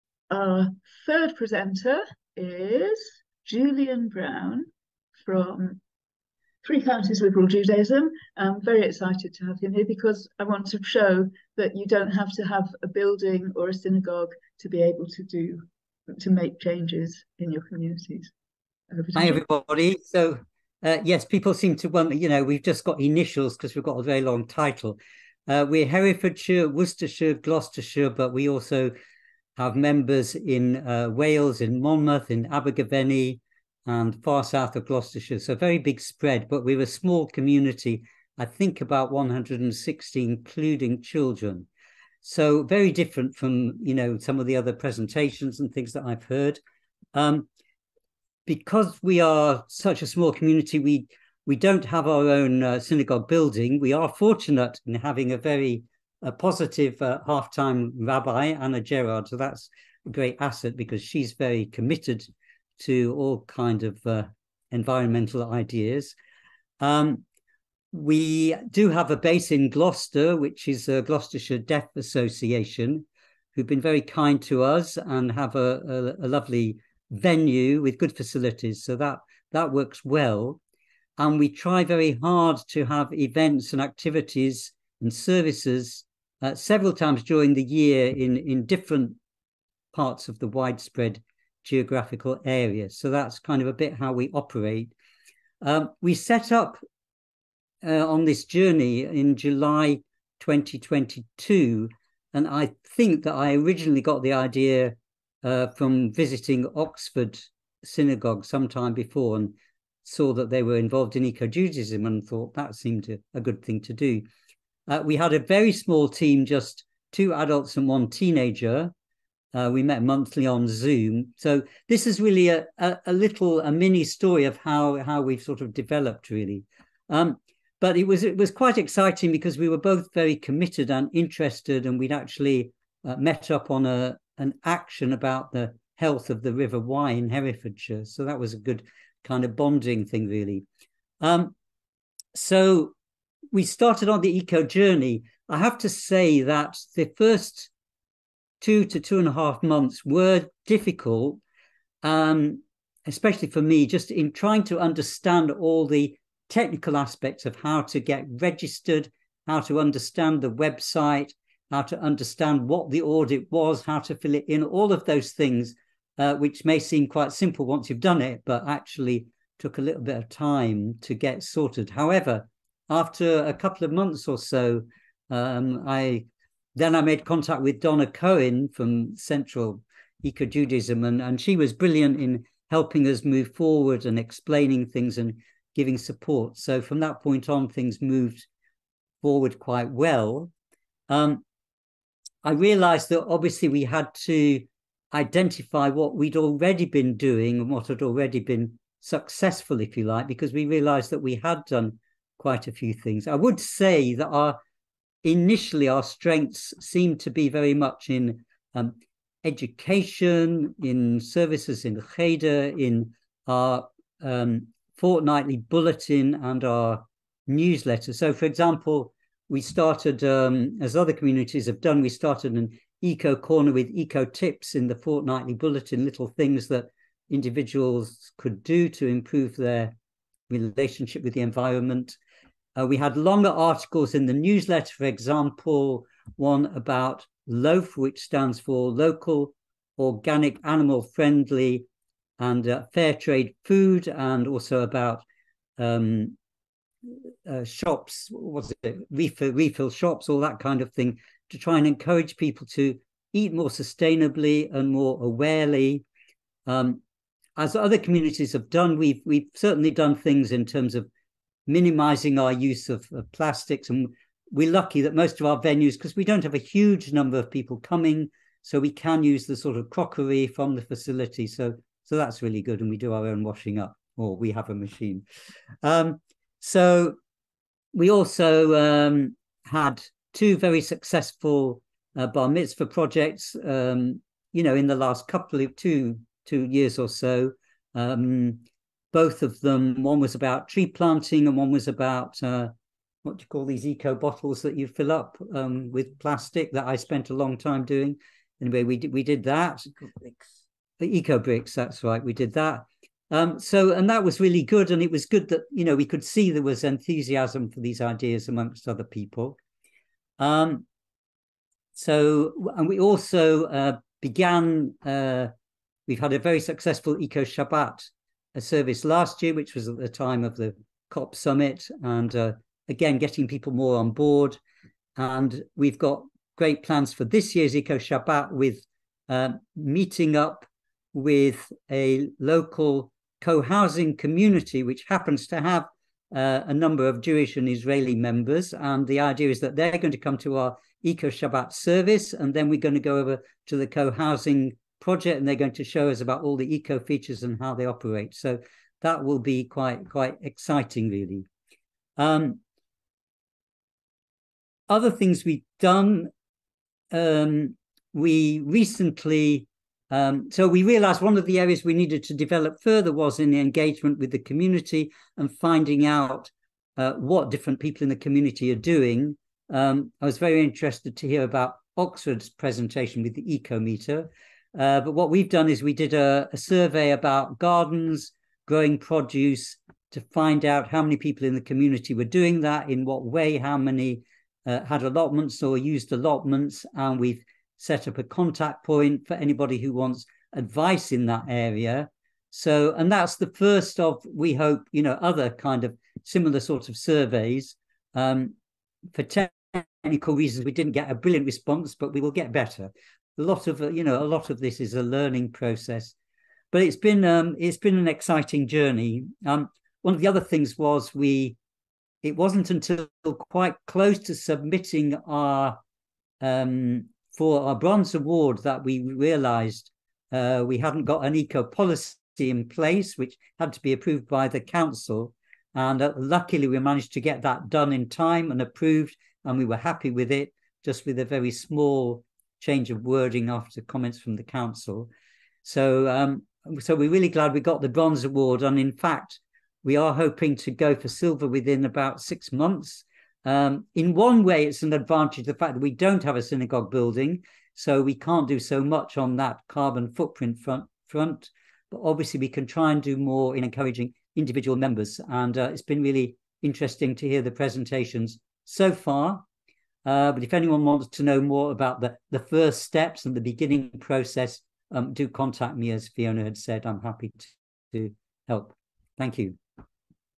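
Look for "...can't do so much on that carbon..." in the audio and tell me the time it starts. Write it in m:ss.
7:28.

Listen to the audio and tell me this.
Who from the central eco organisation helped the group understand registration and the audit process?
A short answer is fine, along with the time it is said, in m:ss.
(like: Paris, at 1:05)
Donna Cohen, at 2:57.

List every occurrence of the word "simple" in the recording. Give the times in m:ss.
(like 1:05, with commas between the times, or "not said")
2:47.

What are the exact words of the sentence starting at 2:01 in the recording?
So this is really a, a, a, little a mini story of how how we've sort of developed really.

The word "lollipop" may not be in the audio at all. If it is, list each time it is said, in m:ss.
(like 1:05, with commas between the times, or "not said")
not said.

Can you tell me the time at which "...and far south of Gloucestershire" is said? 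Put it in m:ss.
0:33.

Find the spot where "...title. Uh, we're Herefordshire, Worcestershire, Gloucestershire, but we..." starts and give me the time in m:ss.
0:24.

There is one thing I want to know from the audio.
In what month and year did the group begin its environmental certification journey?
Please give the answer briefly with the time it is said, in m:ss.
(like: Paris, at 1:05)
July 2022, at 1:39.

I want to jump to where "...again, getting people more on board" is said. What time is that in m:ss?
5:22.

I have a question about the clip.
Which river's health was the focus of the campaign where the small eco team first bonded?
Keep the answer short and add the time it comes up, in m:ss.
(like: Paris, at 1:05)
River Wye, at 2:16.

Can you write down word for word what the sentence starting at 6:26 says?
And we've set up a contact point for anybody who wants advice in that area.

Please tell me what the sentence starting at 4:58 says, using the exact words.
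Anyway, we did, we did that.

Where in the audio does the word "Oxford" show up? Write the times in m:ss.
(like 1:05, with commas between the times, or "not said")
1:46, 6:11.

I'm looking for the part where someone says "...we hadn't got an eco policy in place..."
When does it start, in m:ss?
7:00.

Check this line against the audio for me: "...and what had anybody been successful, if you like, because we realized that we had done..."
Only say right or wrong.
wrong.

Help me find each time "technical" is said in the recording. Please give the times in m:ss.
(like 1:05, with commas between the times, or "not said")
2:36, 6:40.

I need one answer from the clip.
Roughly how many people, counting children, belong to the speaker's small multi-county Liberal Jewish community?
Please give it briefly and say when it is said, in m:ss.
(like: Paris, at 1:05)
160, at 0:39.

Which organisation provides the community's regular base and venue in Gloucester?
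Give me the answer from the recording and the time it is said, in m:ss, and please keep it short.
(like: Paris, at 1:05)
Gloucestershire Deaf Association, at 1:10.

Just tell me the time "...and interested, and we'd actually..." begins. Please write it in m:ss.
2:10.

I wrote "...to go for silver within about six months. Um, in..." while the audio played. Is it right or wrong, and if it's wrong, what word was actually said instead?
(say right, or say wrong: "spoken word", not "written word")
right.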